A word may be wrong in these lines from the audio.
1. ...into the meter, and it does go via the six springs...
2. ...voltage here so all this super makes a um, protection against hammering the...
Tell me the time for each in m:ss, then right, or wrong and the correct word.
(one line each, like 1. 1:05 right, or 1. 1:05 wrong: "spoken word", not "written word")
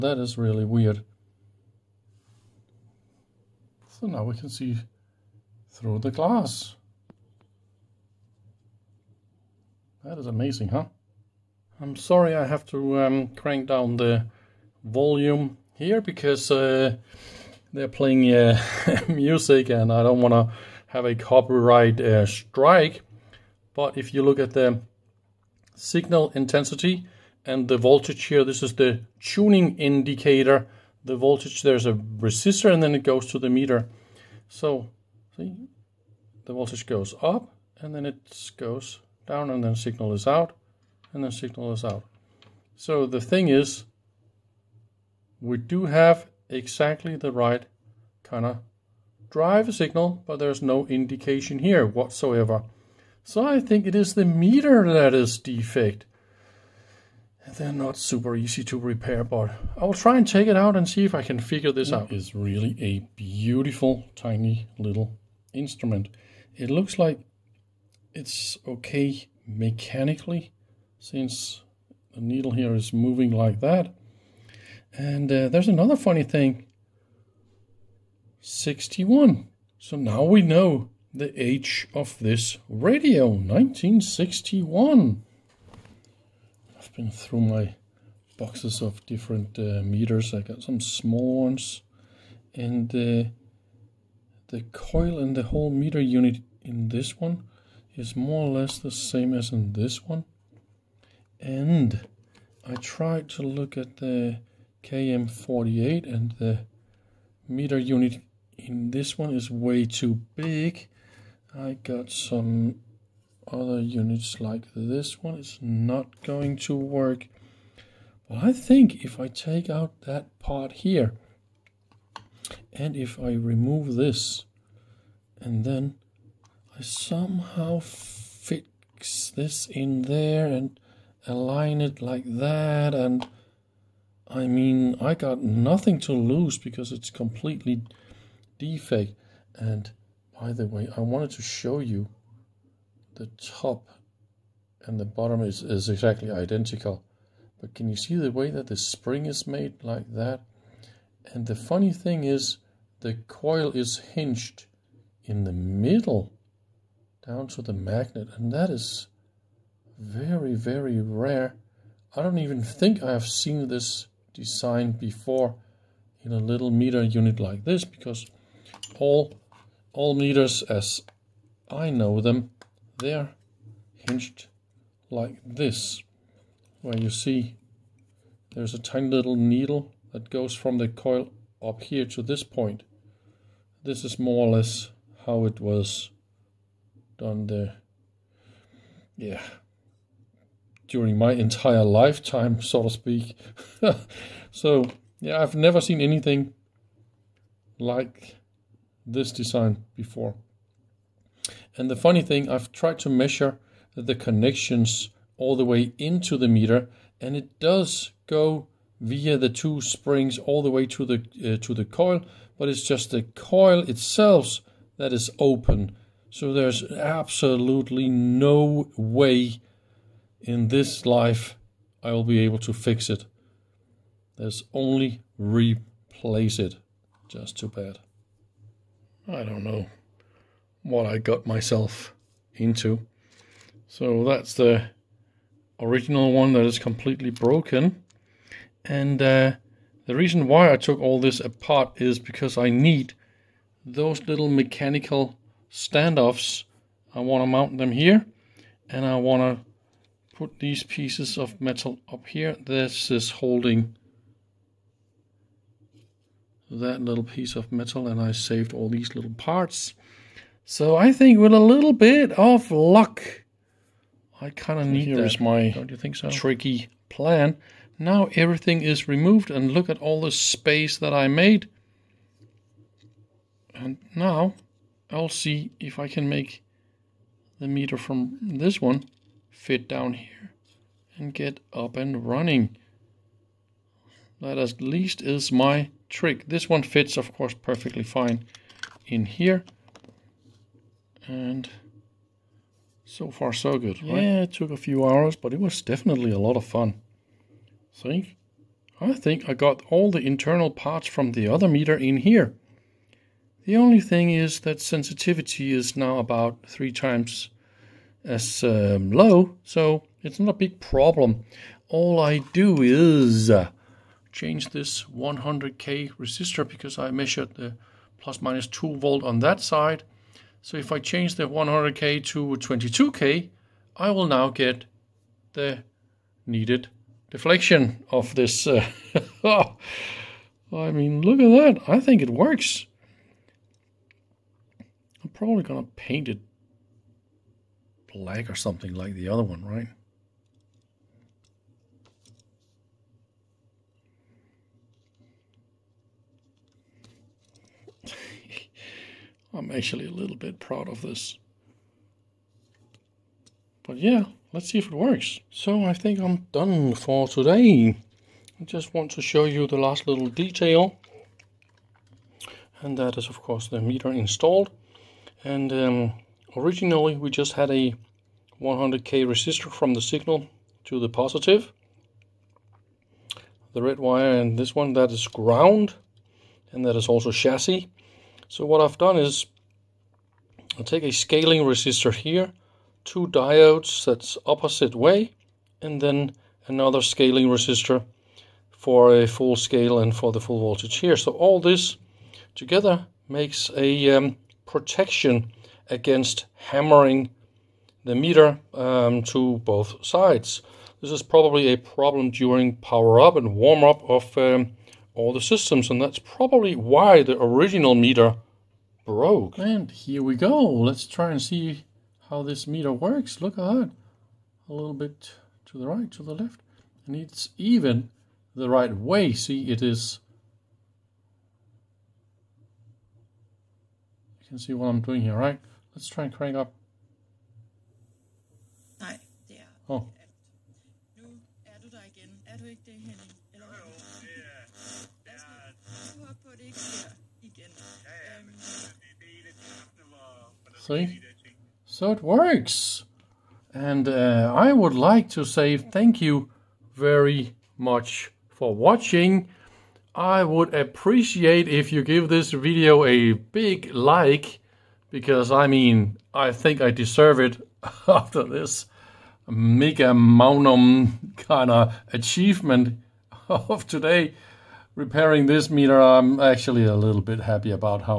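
1. 3:25 wrong: "two", not "six"
2. 6:30 wrong: "together", not "super".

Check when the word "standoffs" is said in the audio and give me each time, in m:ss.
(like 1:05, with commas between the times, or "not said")
4:05.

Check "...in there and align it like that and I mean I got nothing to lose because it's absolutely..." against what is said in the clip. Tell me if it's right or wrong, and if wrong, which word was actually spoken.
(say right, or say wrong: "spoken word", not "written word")
wrong: "completely", not "absolutely".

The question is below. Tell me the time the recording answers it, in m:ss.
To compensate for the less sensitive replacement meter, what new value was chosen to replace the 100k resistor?
5:22.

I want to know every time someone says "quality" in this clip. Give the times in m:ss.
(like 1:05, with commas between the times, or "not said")
not said.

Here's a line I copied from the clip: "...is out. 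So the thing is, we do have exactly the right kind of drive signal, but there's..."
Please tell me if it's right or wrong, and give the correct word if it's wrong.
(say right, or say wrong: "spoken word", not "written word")
right.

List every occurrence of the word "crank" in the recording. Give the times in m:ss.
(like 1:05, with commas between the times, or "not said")
0:13, 7:06.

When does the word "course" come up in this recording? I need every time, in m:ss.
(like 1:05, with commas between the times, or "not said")
4:47, 6:03.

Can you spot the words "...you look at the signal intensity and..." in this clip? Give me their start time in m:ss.
0:24.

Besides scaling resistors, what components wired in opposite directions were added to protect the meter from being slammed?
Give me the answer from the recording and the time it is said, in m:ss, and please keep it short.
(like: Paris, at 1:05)
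2 diodes, at 6:23.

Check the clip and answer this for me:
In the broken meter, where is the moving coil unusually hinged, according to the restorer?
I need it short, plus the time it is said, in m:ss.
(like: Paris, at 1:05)
In the middle, at 2:35.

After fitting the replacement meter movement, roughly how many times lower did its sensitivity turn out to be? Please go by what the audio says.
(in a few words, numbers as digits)
3.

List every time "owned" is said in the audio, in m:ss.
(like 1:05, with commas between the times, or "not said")
not said.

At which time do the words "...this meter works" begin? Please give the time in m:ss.
6:52.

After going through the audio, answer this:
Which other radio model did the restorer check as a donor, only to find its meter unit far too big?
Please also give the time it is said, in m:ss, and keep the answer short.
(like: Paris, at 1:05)
KM48, at 1:44.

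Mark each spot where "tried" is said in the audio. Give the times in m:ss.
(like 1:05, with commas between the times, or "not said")
1:42, 3:22.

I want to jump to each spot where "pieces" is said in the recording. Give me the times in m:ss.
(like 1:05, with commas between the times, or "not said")
4:10, 4:17.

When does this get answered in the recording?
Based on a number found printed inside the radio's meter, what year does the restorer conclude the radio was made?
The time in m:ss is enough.
1:23.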